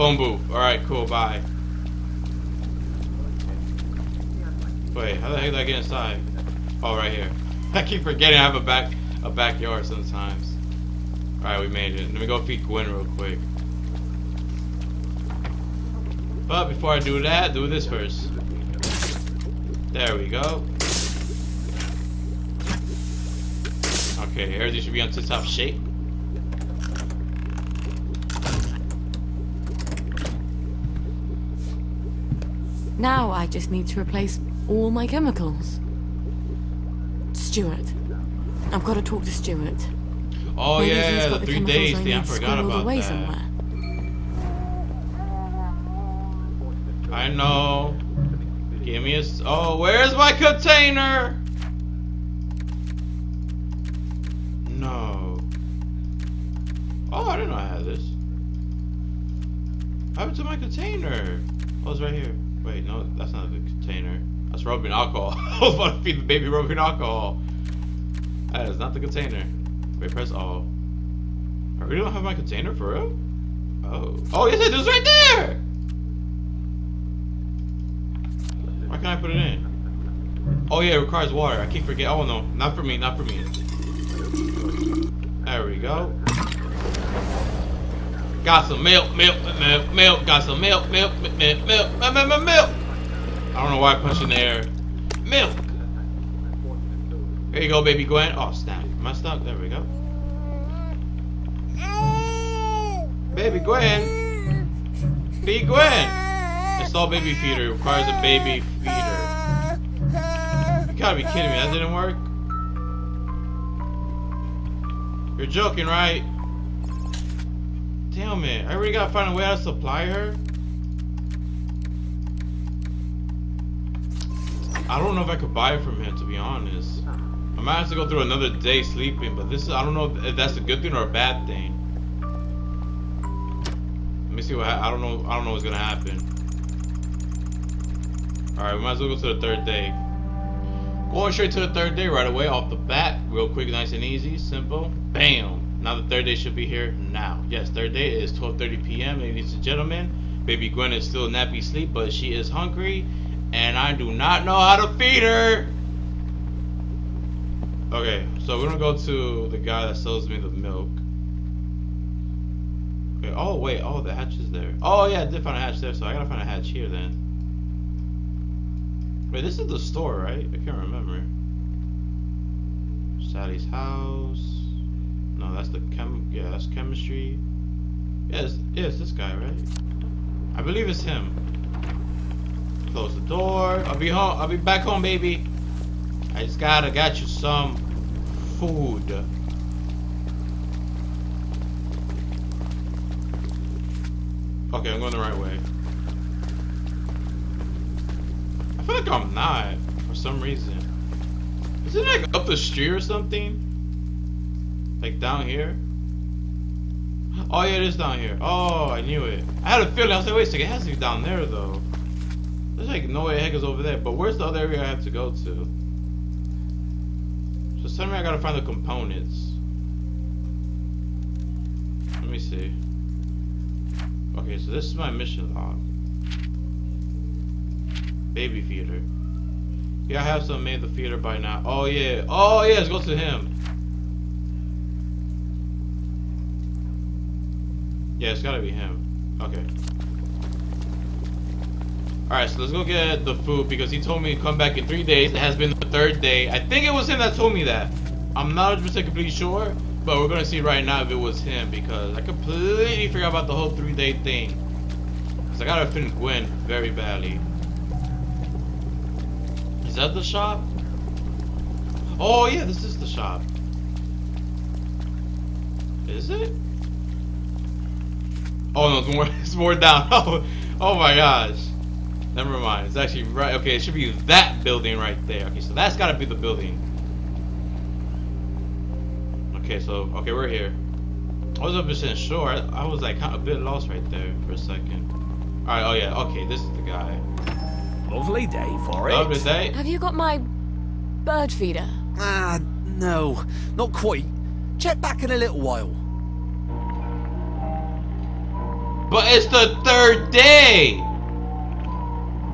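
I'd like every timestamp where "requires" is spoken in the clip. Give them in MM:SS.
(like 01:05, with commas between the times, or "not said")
01:20, 01:47.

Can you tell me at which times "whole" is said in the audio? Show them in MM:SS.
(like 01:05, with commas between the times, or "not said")
04:13.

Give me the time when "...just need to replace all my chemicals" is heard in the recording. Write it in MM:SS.
00:33.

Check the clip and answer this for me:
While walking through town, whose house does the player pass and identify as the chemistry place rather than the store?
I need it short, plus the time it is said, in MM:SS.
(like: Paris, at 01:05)
Sally, at 02:53.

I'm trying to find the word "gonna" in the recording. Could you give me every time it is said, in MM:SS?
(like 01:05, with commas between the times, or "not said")
02:15, 02:38, 04:10.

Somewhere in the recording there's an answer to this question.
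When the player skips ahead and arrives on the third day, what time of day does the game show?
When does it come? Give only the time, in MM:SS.
02:28.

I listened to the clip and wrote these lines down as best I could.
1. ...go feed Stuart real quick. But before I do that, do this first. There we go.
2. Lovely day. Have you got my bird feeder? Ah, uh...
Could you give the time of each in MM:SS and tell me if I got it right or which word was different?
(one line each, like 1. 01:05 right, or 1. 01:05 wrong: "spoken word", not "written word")
1. 00:12 wrong: "Gwen", not "Stuart"
2. 04:49 right.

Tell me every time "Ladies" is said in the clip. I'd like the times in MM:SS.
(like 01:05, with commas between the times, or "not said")
02:29.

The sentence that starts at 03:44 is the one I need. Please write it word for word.
Okay, so this is my mission log.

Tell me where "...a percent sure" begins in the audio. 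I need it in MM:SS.
04:41.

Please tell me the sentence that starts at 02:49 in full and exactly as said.
Wait, this is the store, right?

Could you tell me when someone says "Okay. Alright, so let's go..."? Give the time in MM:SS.
03:59.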